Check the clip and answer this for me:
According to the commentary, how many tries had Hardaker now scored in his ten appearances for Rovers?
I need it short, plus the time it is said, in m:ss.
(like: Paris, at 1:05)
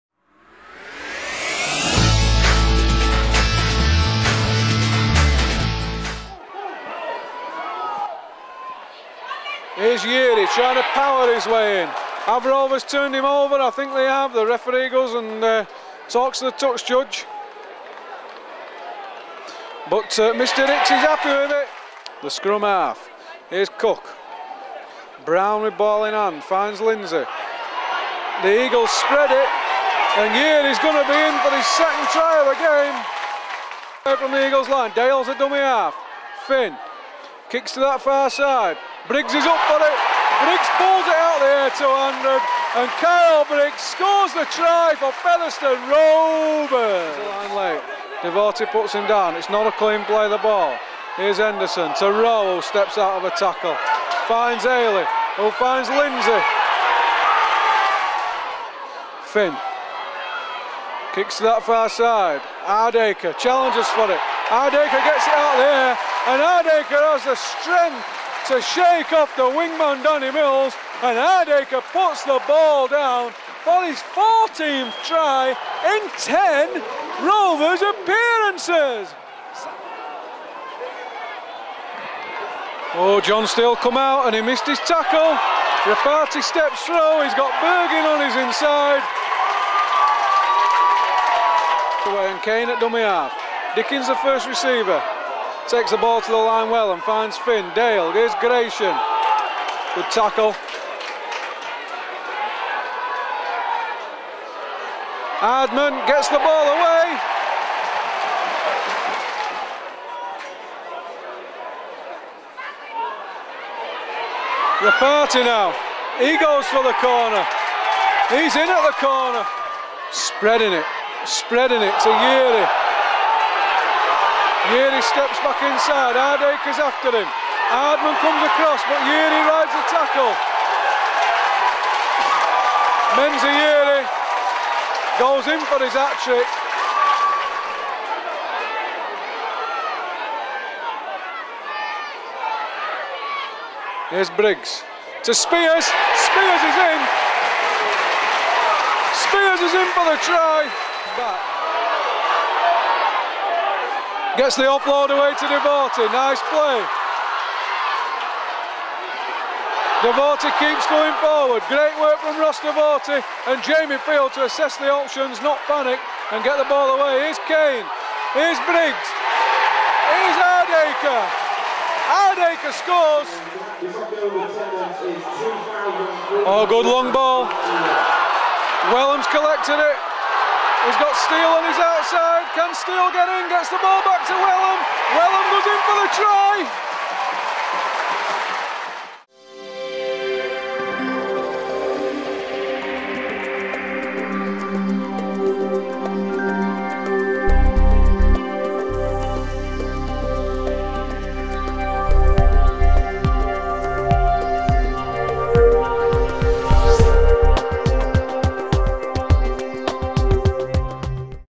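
14, at 1:14.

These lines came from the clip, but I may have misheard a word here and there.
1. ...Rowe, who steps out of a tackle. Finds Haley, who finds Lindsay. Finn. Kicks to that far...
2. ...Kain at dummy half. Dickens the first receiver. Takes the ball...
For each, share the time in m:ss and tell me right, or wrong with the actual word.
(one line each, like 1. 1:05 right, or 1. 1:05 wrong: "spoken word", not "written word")
1. 0:52 right
2. 1:32 right.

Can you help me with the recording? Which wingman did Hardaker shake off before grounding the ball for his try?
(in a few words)
Danny Mills.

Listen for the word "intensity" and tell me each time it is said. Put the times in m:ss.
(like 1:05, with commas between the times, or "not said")
not said.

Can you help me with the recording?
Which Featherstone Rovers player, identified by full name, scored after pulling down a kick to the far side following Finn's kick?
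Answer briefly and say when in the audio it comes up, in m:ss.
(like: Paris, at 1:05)
Kyle Briggs, at 0:43.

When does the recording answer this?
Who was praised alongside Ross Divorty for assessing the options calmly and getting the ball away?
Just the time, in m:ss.
2:43.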